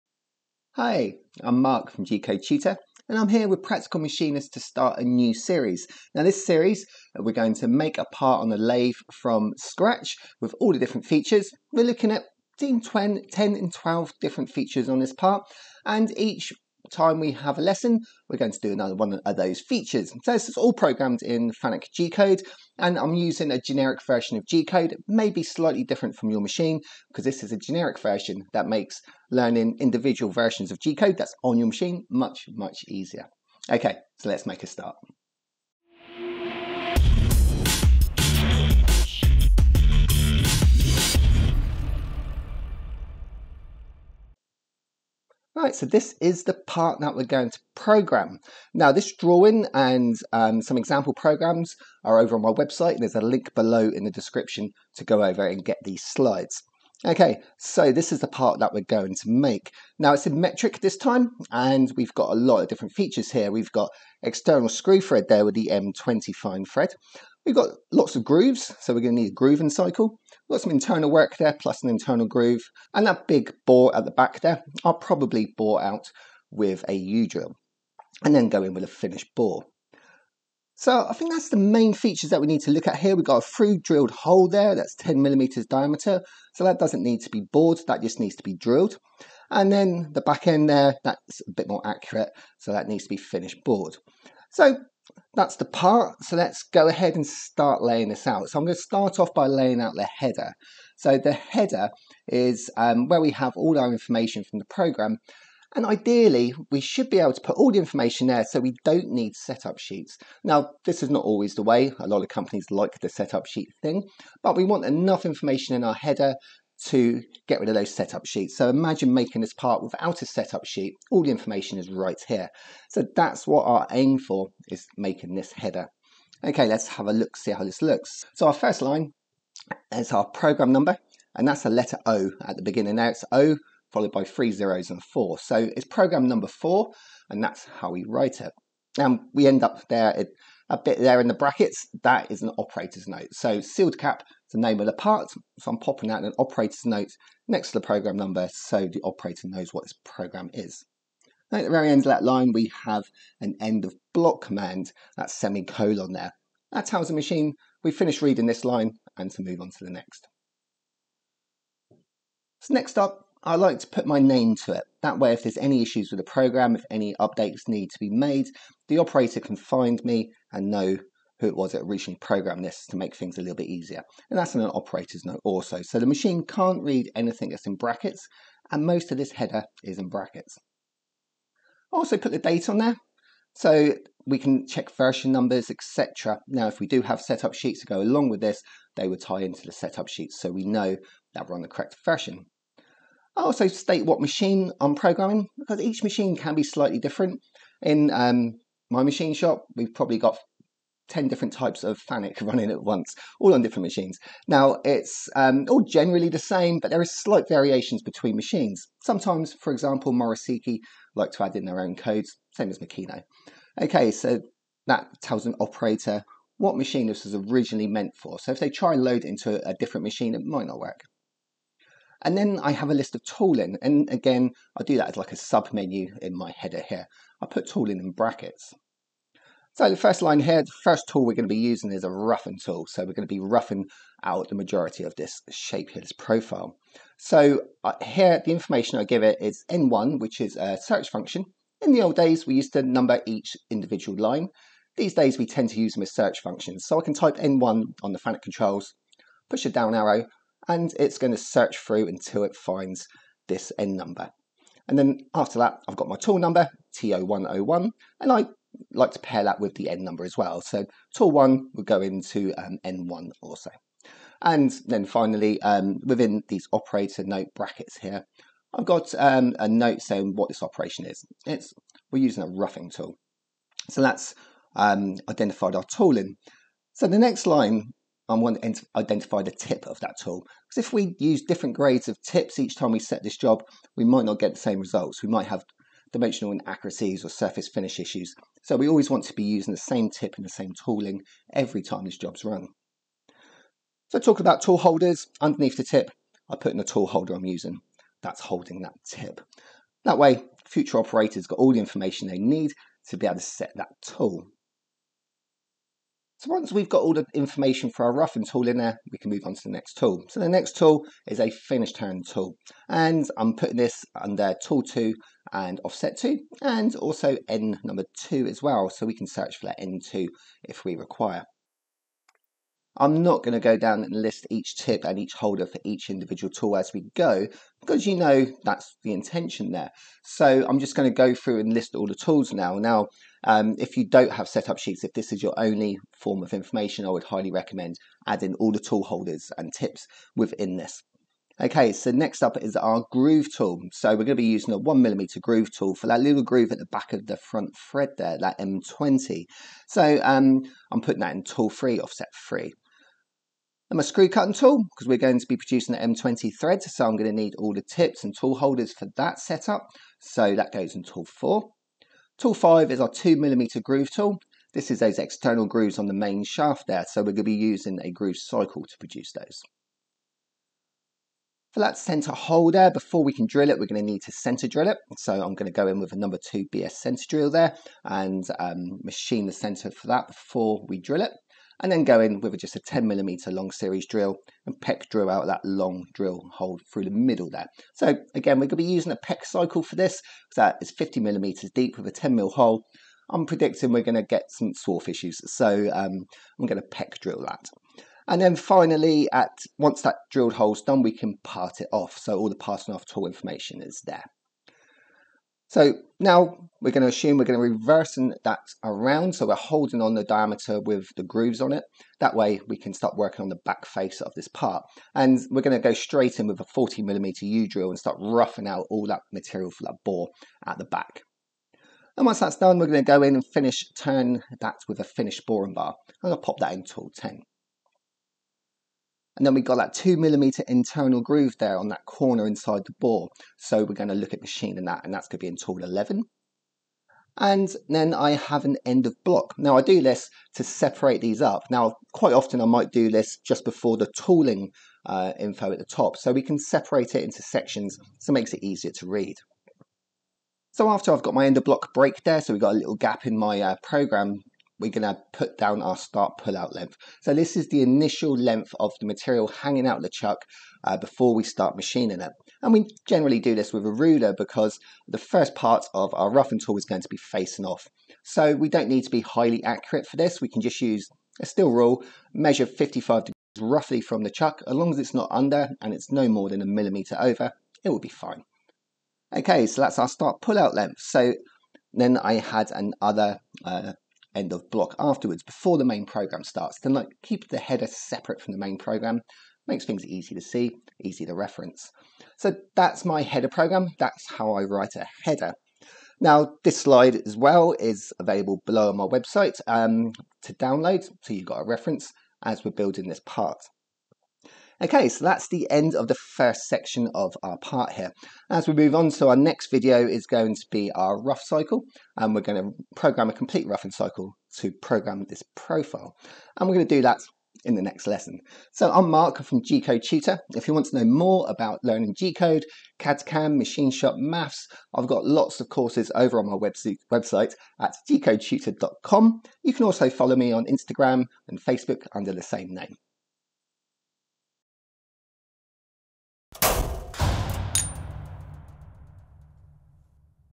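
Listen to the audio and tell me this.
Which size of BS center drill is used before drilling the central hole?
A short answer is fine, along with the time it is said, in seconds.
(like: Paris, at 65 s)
Number 2, at 376 s.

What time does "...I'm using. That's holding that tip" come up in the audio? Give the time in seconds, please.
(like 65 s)
297 s.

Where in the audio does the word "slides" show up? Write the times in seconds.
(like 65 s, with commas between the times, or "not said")
56 s, 496 s.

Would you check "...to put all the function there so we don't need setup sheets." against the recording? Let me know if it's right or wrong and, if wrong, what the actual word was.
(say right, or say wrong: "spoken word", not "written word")
wrong: "information", not "function".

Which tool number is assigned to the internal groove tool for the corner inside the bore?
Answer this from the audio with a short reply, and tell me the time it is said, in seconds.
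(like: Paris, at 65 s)
11, at 435 s.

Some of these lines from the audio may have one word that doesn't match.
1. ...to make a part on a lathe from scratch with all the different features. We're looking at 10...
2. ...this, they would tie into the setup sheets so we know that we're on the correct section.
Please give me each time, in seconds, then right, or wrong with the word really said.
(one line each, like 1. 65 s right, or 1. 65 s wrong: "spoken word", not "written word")
1. 7 s right
2. 188 s wrong: "version", not "section".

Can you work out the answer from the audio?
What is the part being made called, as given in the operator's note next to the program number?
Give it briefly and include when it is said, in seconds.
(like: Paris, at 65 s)
Sealed cap, at 143 s.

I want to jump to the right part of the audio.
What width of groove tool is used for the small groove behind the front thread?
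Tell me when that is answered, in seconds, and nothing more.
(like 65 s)
344 s.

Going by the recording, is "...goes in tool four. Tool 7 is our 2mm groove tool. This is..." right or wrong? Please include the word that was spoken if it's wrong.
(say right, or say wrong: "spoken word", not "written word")
wrong: "5", not "7".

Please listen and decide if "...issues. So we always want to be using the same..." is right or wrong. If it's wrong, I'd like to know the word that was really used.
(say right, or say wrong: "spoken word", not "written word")
right.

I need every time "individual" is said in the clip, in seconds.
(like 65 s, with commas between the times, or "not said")
29 s, 243 s, 326 s.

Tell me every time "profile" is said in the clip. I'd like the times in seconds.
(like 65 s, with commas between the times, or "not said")
236 s, 515 s.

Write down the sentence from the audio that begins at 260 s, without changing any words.
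So tool one would go into um, n1 also.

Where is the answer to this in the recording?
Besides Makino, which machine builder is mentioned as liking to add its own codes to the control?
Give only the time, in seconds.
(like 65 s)
210 s.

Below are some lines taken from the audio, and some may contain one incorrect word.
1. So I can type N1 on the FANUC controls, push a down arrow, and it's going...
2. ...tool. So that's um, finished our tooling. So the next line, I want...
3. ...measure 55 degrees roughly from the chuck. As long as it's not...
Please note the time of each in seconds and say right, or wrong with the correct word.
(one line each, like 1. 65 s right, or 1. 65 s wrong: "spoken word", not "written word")
1. 246 s right
2. 272 s wrong: "identified", not "finished"
3. 472 s right.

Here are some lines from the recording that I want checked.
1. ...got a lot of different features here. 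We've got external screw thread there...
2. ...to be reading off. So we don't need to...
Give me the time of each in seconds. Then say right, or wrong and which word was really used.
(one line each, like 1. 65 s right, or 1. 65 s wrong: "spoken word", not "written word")
1. 62 s right
2. 467 s wrong: "facing", not "reading".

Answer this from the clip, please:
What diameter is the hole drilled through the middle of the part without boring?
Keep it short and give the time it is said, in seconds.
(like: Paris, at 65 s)
10 millimeters, at 84 s.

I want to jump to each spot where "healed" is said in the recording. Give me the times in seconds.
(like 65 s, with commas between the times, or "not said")
not said.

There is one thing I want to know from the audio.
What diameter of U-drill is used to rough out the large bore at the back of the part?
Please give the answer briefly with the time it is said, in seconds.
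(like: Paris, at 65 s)
40 millimeters, at 416 s.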